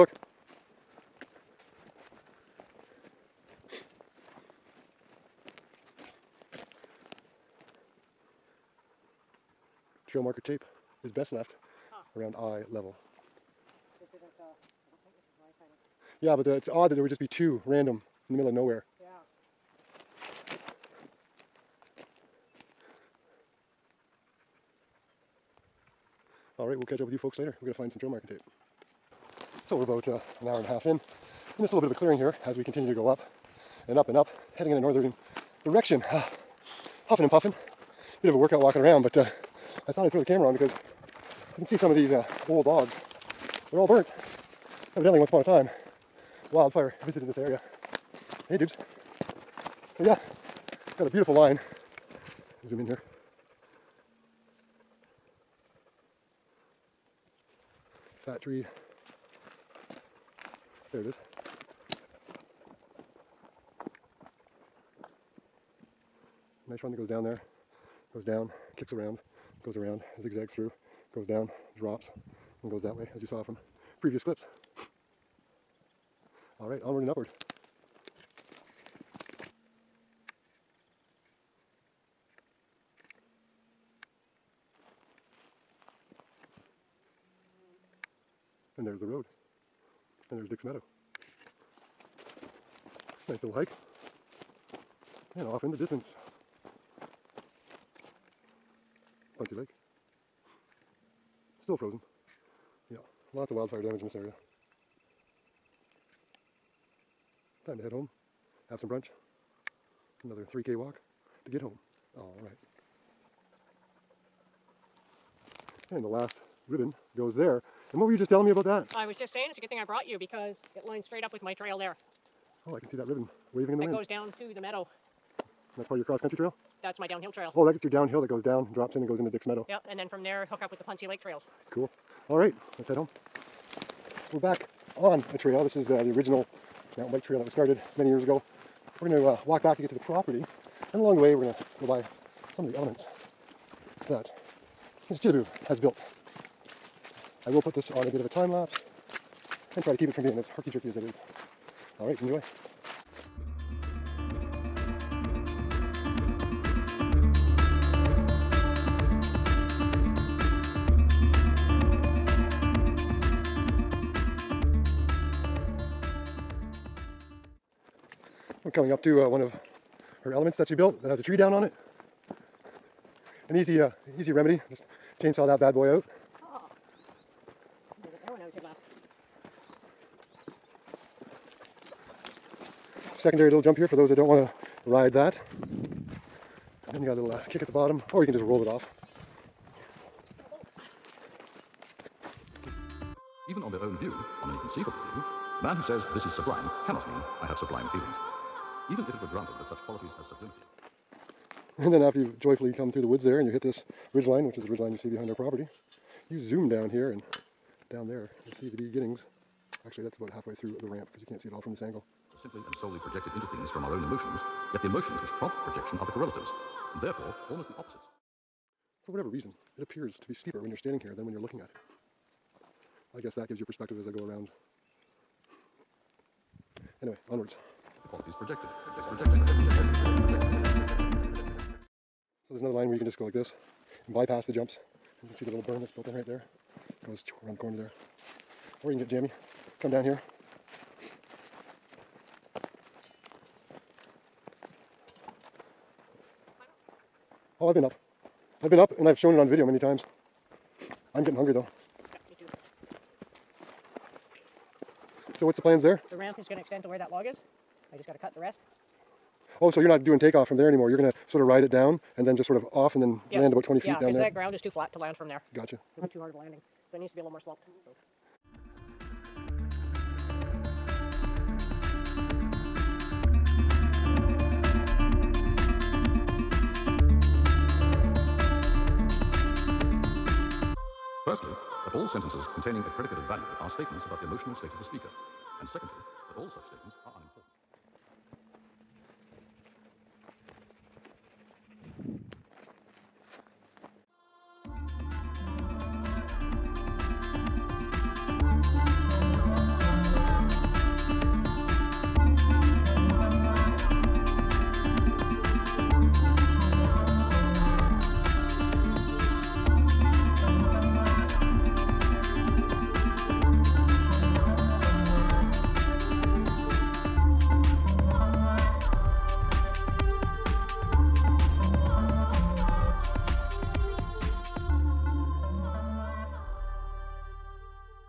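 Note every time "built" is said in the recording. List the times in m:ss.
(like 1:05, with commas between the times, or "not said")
2:25, 2:50, 3:55.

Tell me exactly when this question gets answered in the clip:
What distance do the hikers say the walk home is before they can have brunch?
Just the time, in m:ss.
1:50.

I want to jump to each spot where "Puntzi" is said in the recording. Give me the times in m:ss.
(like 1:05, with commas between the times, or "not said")
1:39, 2:10.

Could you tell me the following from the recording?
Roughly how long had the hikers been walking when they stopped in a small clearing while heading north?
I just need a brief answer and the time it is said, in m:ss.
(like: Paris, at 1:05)
an hour and a half, at 0:30.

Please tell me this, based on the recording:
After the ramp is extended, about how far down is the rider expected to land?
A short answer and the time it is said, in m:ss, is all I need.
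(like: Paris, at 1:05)
20 feet, at 4:23.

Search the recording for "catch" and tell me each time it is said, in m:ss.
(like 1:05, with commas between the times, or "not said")
0:26.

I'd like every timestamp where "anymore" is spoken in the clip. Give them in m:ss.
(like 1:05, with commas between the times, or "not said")
4:20.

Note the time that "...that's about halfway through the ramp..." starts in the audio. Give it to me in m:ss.
3:30.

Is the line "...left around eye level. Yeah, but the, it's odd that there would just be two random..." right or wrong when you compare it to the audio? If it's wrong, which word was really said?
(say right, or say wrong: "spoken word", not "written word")
right.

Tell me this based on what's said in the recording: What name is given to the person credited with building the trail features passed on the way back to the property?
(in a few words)
Mr. Chili Bu.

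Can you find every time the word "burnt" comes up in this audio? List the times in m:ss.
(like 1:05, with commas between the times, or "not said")
0:43.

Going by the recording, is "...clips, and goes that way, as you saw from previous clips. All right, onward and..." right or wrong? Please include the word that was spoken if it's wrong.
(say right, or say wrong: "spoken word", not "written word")
wrong: "drops", not "clips".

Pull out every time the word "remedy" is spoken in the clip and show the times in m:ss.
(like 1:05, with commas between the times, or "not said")
2:54.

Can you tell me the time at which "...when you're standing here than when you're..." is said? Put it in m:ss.
3:40.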